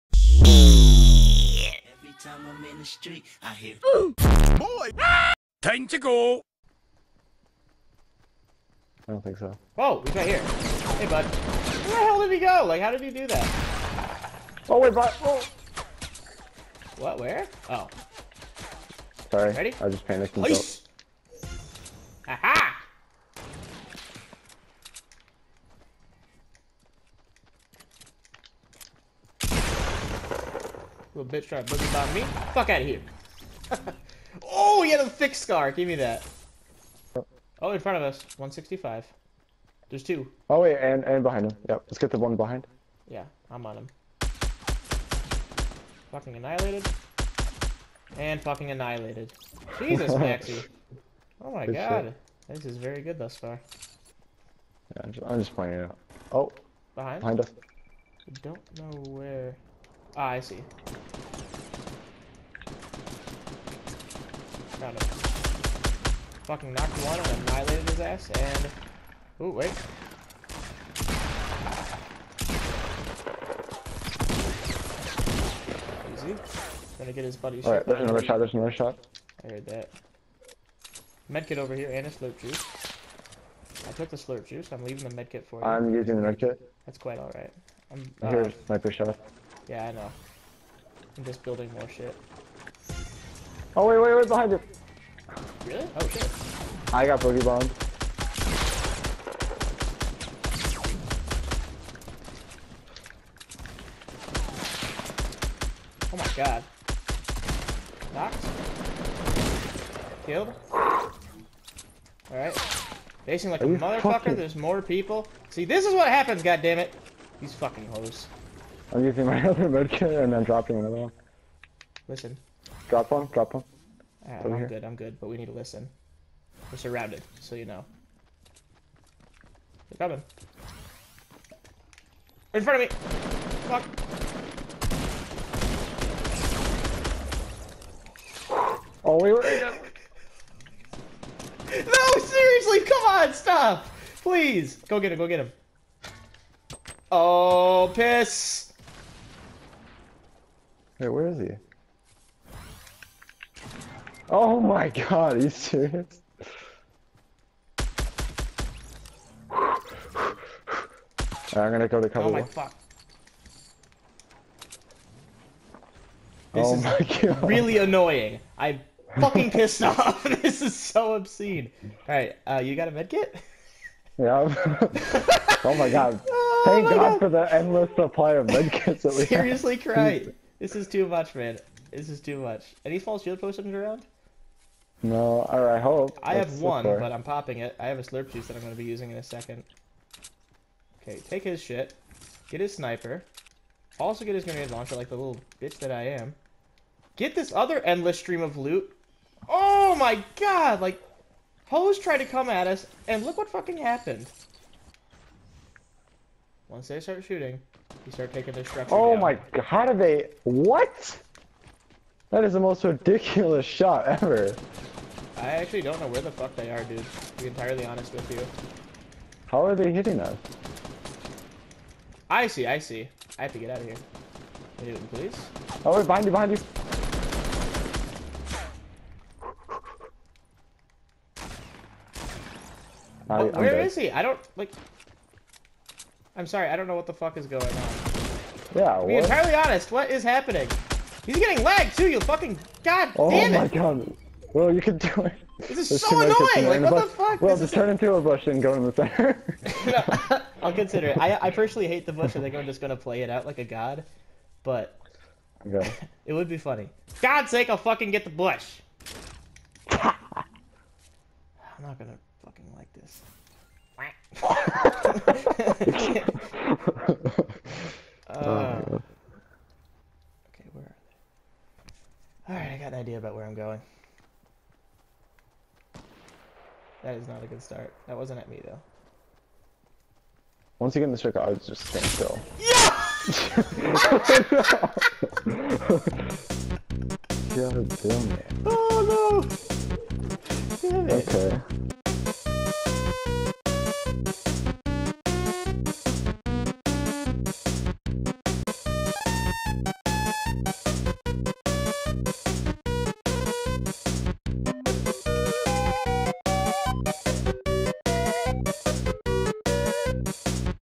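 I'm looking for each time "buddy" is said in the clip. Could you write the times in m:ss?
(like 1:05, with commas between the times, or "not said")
1:17.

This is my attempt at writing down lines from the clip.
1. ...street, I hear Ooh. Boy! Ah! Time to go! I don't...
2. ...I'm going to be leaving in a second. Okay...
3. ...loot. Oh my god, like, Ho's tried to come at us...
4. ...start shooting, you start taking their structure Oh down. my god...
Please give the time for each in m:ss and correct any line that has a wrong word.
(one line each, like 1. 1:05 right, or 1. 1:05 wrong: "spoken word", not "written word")
1. 0:02 right
2. 3:08 wrong: "using", not "leaving"
3. 3:18 right
4. 3:27 right.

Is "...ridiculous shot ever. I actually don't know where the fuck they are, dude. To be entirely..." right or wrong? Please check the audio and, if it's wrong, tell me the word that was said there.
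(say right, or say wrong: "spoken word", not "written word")
right.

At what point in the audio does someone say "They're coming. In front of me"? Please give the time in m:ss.
2:09.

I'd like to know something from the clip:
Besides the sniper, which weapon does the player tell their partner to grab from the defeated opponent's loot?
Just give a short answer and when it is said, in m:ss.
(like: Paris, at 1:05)
grenade launcher, at 3:14.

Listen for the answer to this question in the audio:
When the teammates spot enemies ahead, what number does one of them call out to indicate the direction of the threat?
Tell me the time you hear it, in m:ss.
0:38.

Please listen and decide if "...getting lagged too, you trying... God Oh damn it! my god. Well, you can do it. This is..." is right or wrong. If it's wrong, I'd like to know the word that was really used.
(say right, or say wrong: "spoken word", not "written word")
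wrong: "fucking", not "trying".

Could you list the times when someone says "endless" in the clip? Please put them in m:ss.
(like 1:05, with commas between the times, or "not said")
2:57, 3:17.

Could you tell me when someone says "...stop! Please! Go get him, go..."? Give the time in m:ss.
2:23.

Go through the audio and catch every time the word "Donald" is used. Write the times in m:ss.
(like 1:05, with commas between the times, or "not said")
not said.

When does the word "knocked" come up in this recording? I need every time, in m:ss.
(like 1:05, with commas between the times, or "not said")
1:06, 1:48.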